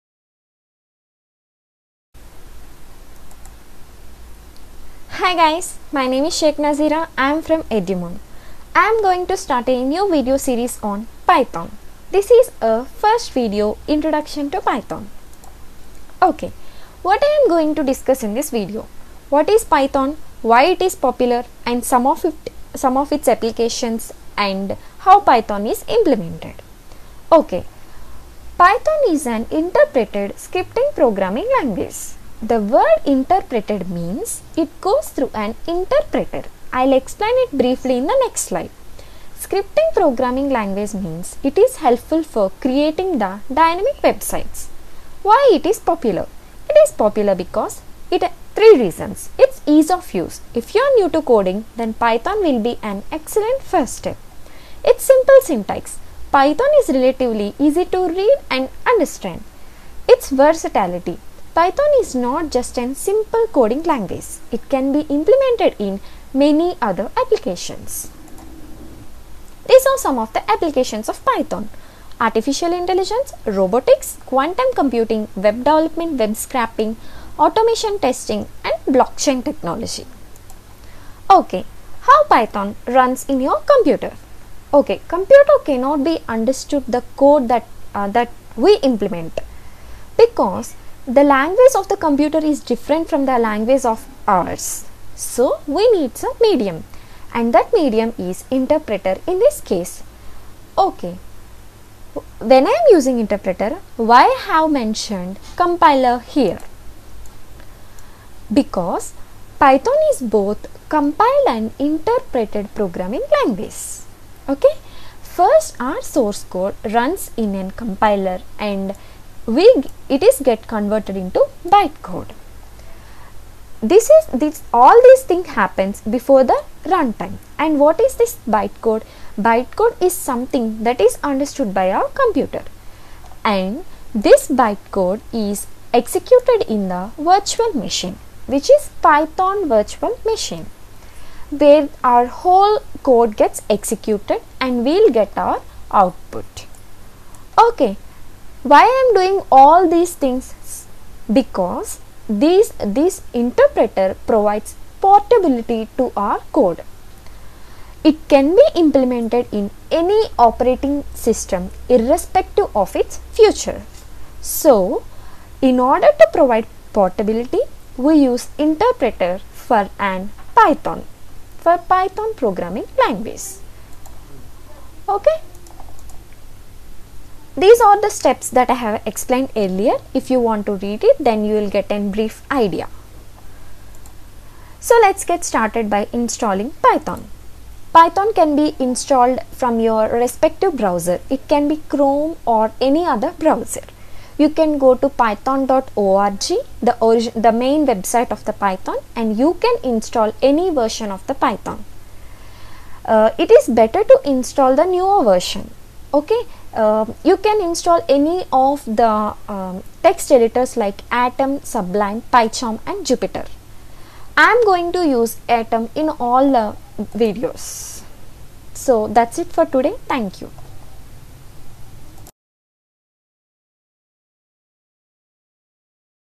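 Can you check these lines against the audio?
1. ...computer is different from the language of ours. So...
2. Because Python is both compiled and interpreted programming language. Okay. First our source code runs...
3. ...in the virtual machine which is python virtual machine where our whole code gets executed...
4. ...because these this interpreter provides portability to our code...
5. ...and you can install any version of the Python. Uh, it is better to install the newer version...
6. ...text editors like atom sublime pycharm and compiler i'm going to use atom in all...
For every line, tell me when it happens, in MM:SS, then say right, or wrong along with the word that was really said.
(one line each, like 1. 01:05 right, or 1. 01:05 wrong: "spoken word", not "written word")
1. 01:31 right
2. 01:48 right
3. 02:16 right
4. 02:31 right
5. 03:19 right
6. 03:30 wrong: "jupyter", not "compiler".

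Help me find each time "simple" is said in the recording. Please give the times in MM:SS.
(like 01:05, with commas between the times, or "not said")
00:55, 01:02.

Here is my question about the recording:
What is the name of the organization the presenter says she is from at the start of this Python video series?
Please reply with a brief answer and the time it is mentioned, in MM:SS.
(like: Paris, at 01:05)
EduMoon, at 00:07.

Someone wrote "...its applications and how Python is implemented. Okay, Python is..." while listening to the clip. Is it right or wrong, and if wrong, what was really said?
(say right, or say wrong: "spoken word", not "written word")
right.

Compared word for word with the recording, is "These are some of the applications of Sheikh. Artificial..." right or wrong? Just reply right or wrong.
wrong.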